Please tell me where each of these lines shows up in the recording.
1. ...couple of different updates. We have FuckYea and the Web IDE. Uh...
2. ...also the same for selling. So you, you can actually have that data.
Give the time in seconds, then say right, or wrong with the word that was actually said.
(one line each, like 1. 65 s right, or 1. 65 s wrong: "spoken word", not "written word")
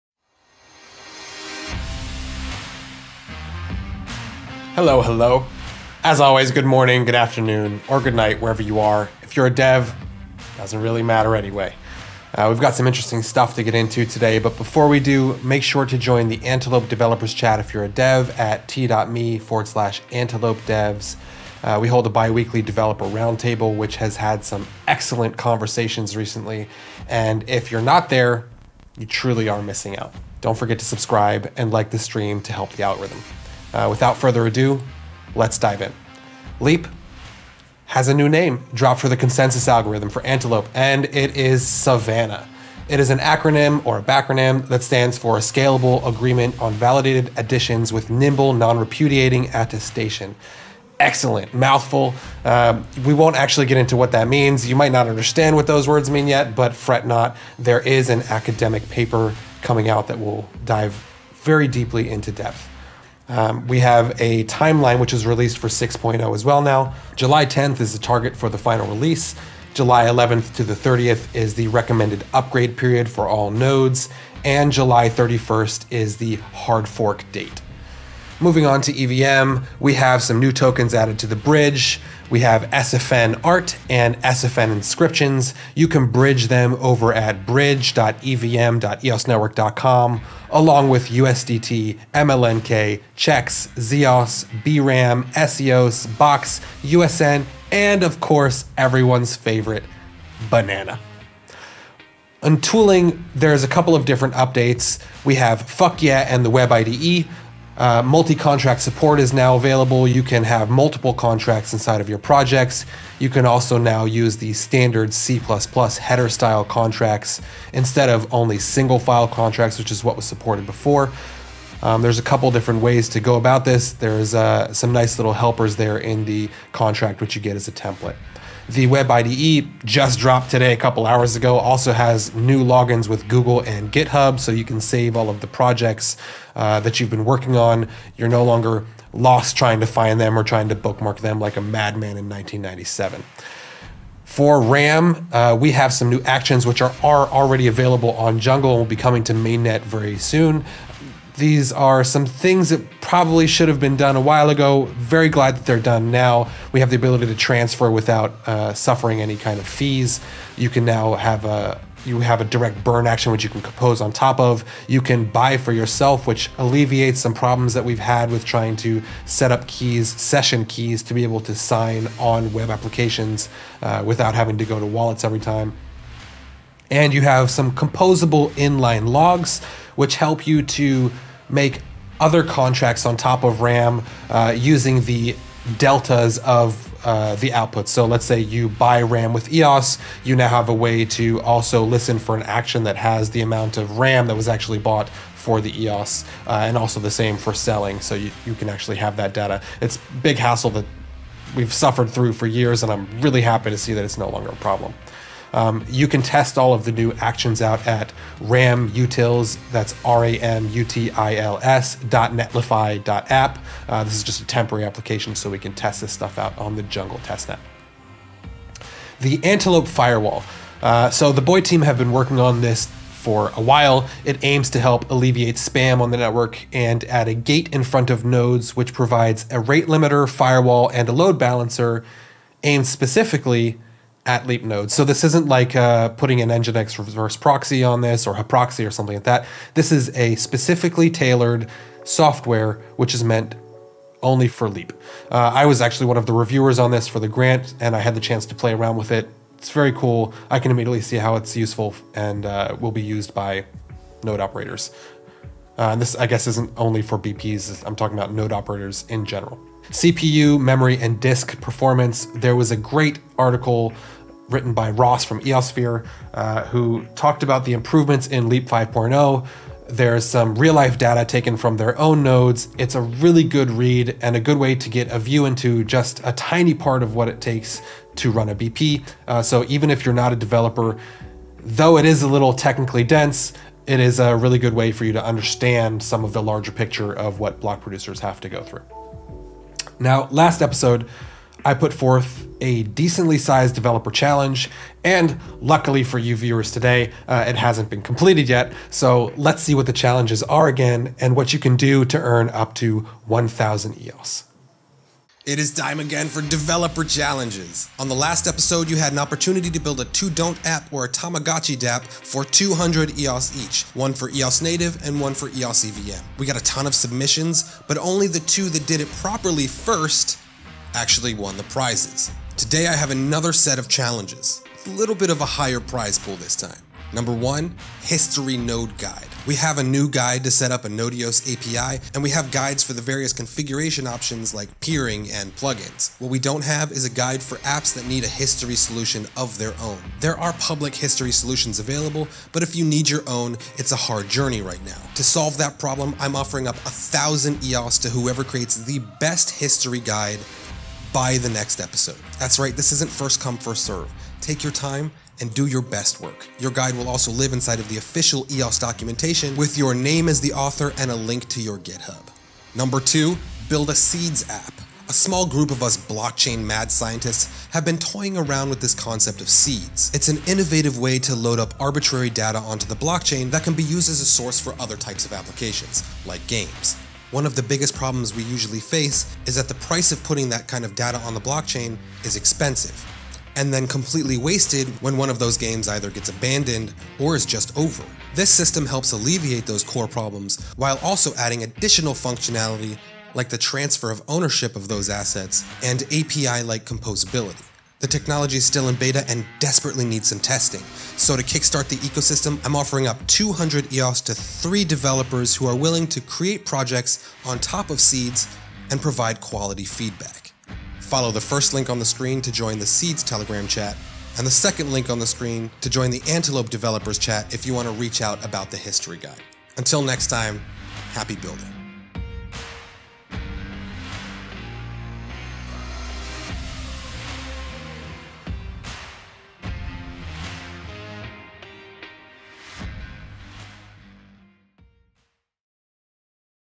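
1. 103 s right
2. 196 s right.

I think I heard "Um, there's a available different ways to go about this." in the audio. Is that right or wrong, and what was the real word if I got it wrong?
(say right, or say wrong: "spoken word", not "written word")
wrong: "couple", not "available".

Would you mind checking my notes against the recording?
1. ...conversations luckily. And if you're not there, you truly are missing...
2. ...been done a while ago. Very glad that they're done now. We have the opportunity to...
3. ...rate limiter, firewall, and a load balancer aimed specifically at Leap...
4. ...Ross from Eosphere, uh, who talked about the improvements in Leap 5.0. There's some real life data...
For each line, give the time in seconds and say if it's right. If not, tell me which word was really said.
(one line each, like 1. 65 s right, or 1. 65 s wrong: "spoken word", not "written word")
1. 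25 s wrong: "recently", not "luckily"
2. 153 s wrong: "ability", not "opportunity"
3. 229 s right
4. 264 s right.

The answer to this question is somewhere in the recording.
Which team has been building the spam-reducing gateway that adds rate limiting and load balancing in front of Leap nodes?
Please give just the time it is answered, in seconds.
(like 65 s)
221 s.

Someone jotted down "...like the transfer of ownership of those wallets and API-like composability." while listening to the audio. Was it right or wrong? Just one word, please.
wrong.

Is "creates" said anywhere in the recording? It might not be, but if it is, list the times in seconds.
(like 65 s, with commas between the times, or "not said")
348 s, 406 s.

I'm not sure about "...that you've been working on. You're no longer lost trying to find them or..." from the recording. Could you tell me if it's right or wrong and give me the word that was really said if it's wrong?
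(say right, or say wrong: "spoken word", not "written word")
right.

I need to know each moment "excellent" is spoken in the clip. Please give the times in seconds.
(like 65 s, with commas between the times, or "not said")
24 s, 50 s.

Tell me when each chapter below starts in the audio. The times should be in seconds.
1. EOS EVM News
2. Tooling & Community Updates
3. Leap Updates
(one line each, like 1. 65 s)
1. 79 s
2. 101 s
3. 37 s.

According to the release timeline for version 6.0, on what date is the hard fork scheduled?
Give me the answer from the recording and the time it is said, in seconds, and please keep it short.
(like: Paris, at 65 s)
July 31st, at 74 s.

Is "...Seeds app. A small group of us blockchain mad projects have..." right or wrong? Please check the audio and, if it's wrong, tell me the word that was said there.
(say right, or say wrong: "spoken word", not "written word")
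wrong: "scientists", not "projects".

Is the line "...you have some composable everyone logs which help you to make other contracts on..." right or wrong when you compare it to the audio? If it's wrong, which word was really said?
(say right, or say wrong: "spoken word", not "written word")
wrong: "inline", not "everyone".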